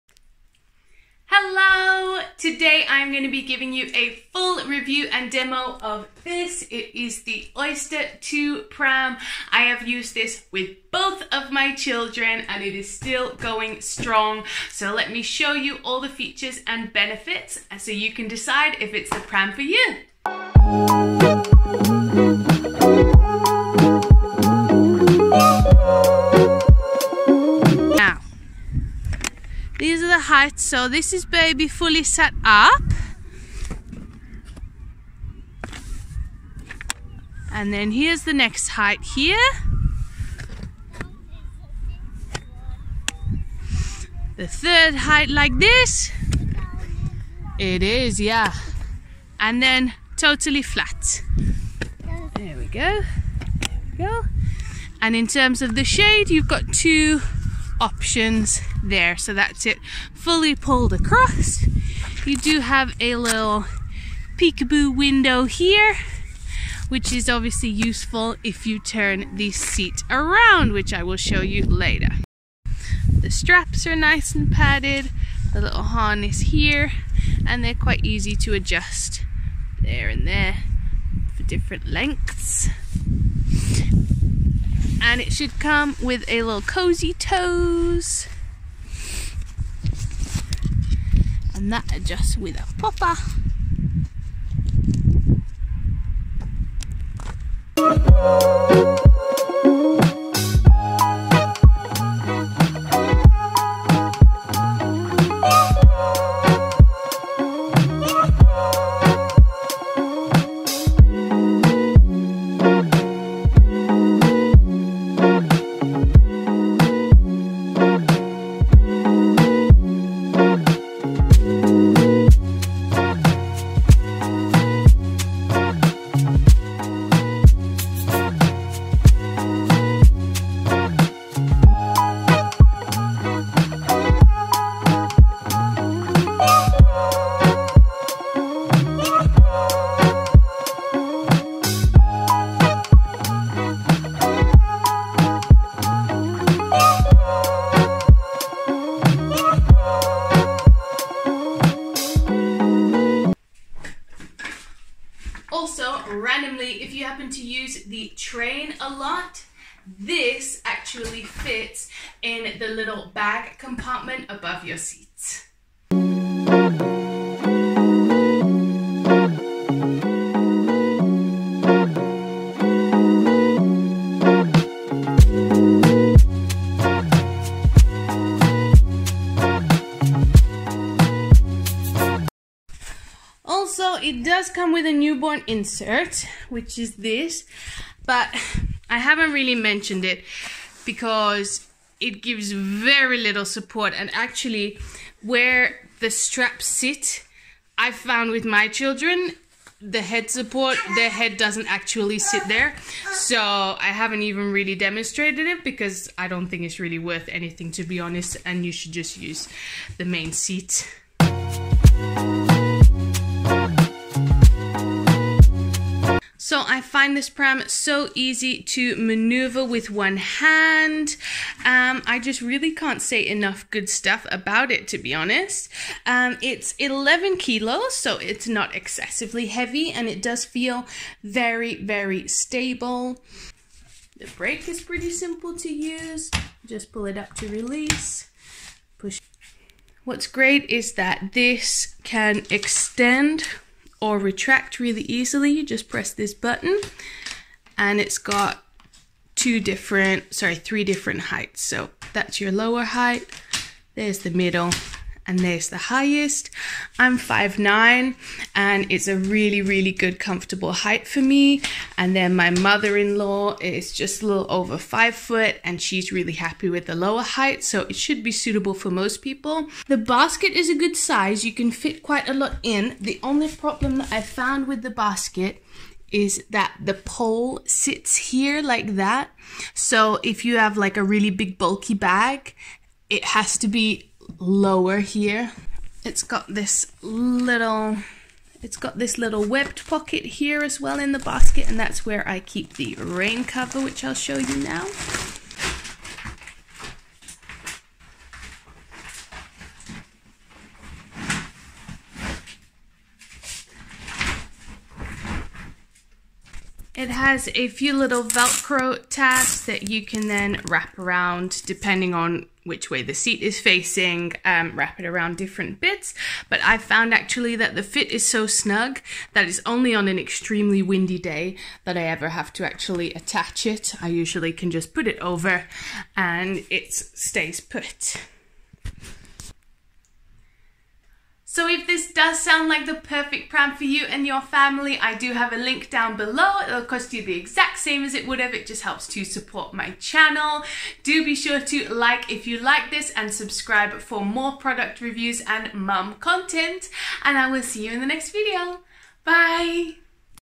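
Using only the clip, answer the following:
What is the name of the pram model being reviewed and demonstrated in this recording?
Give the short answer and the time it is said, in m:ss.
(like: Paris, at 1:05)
Oyster 2, at 0:07.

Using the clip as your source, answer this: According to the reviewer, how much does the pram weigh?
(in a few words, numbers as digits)
11 kilos.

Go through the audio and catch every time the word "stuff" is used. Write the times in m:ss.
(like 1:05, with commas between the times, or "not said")
3:43.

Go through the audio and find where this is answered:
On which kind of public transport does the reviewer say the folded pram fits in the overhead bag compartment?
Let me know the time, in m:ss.
2:38.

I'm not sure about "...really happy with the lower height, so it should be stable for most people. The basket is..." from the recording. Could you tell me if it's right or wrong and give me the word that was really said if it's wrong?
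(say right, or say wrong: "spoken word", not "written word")
wrong: "suitable", not "stable".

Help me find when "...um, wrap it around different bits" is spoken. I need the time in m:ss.
5:14.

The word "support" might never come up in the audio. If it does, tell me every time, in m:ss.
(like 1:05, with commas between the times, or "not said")
3:13, 3:20, 5:39.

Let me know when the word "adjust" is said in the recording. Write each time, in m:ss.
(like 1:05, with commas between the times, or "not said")
1:18, 1:31.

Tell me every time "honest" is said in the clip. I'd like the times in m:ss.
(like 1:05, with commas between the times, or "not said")
3:28, 3:45.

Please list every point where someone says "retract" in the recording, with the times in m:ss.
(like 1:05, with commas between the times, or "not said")
4:04.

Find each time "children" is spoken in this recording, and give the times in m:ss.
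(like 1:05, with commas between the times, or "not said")
0:11, 3:18.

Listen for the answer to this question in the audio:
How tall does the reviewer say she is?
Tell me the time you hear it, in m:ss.
4:17.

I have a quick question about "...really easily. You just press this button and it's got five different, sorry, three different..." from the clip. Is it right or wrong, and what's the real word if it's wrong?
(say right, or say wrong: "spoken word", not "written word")
wrong: "two", not "five".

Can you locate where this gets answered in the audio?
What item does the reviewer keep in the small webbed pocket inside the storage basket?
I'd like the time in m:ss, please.
4:52.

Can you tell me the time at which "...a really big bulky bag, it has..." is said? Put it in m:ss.
4:40.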